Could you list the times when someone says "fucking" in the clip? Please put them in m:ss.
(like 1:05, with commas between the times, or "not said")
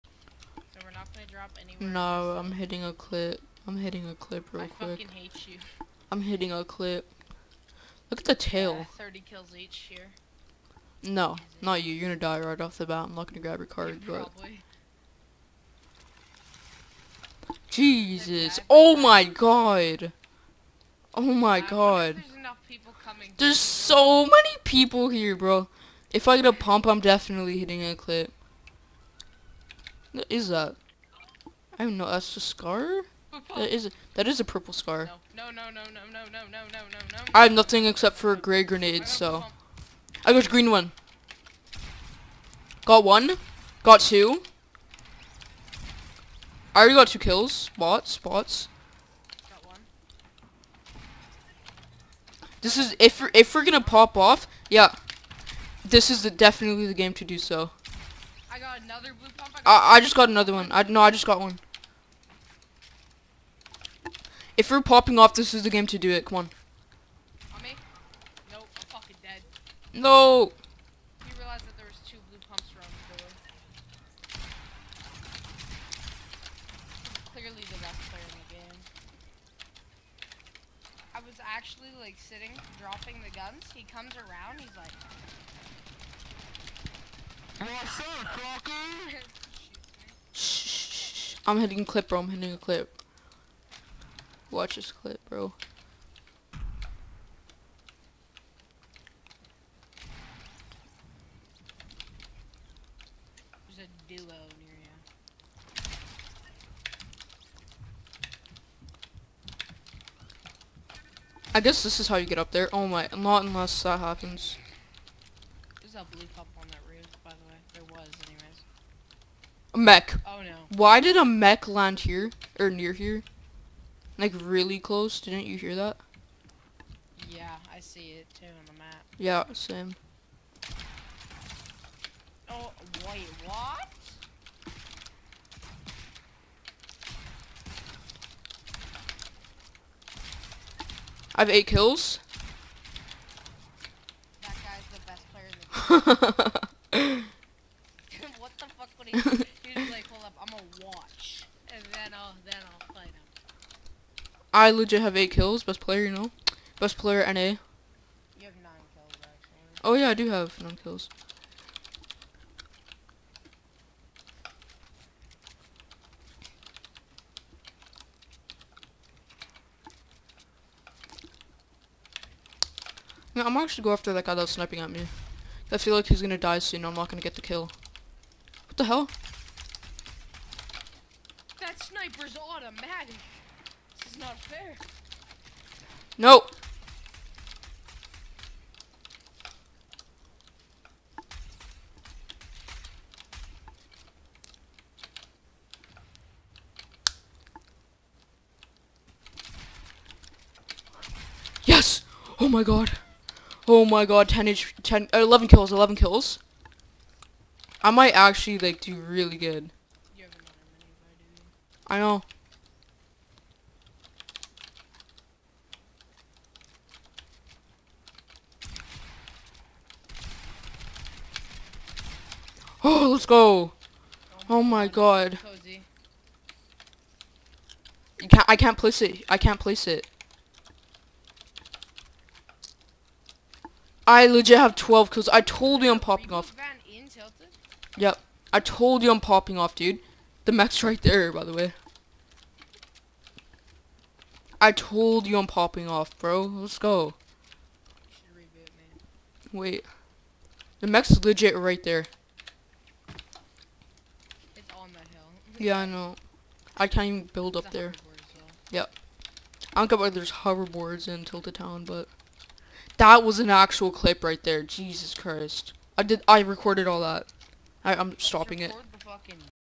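0:04, 1:08.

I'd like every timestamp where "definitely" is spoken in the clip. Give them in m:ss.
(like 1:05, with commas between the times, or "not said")
0:26, 0:56.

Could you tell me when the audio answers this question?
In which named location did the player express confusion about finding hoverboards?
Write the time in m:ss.
4:21.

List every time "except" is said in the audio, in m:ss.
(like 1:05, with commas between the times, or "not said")
0:37.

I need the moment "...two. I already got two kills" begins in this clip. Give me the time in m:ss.
0:44.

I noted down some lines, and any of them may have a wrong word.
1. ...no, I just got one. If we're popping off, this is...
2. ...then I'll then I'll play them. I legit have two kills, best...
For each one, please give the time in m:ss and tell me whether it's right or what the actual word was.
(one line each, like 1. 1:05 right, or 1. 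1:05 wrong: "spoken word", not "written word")
1. 1:00 right
2. 2:32 wrong: "eight", not "two".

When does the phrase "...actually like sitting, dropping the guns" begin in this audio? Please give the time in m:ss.
1:21.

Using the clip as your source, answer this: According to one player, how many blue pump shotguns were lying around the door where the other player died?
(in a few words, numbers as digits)
2.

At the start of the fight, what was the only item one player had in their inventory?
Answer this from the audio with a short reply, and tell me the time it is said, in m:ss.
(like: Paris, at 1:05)
Gray grenade, at 0:38.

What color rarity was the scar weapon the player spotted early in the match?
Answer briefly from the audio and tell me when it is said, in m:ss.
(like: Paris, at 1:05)
Purple, at 0:34.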